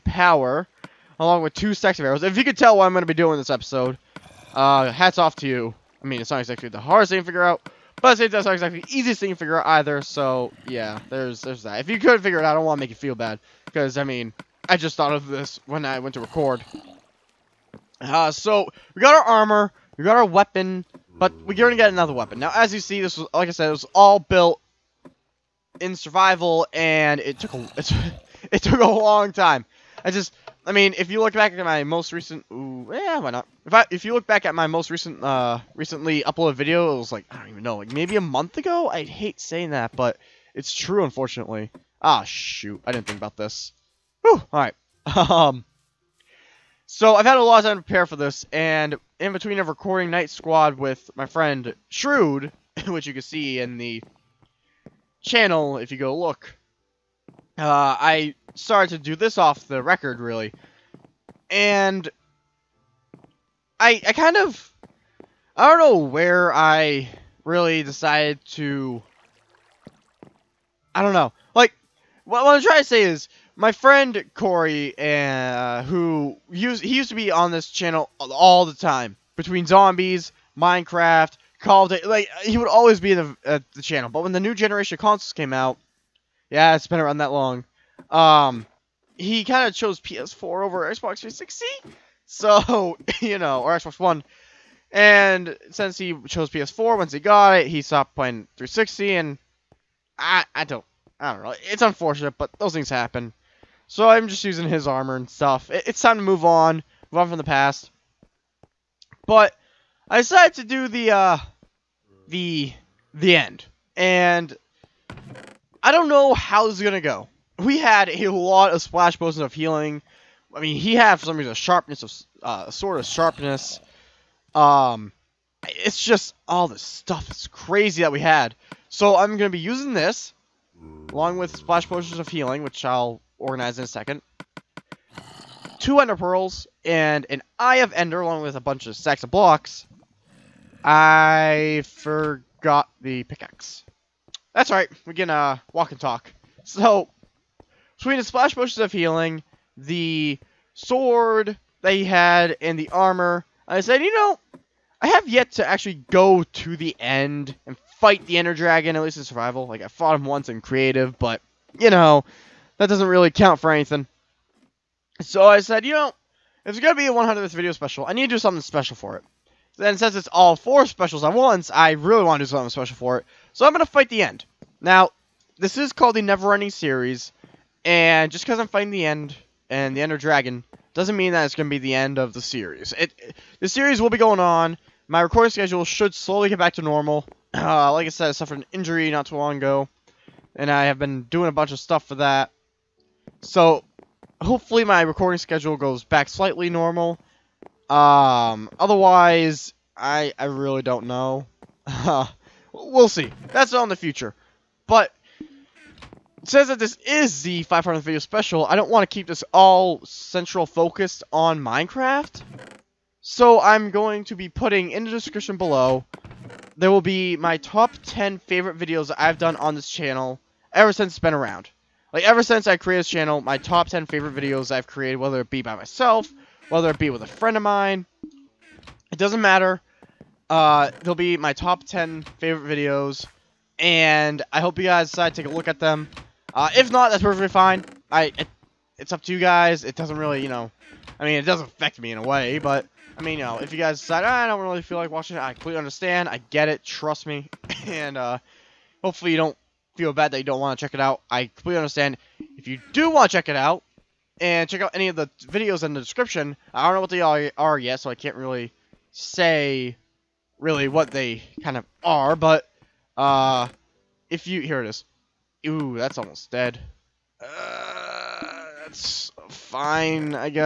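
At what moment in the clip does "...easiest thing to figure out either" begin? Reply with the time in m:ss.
0:08.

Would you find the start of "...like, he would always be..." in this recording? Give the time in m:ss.
1:22.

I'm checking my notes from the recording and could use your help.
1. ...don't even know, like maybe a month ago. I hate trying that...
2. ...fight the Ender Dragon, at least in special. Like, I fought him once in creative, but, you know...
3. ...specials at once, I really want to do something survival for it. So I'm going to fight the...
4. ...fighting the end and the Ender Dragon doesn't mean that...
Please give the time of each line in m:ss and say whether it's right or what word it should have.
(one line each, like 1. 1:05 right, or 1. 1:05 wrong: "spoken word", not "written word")
1. 0:37 wrong: "saying", not "trying"
2. 2:37 wrong: "survival", not "special"
3. 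2:50 wrong: "special", not "survival"
4. 2:58 right.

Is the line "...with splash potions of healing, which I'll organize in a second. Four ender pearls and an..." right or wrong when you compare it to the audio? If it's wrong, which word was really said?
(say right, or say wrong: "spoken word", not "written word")
wrong: "Two", not "Four".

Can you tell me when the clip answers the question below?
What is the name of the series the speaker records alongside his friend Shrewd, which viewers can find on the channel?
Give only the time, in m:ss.
0:50.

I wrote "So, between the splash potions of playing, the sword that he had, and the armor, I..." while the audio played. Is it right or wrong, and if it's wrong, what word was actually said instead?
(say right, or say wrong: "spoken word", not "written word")
wrong: "healing", not "playing".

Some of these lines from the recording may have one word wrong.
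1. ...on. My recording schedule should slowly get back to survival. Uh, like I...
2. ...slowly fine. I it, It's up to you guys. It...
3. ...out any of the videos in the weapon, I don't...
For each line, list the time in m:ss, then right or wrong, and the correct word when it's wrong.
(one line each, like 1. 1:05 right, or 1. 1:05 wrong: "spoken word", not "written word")
1. 3:04 wrong: "normal", not "survival"
2. 3:57 wrong: "perfectly", not "slowly"
3. 4:14 wrong: "description", not "weapon".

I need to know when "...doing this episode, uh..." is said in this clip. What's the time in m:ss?
0:03.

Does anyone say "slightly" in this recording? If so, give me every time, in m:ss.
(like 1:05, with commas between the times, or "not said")
3:16.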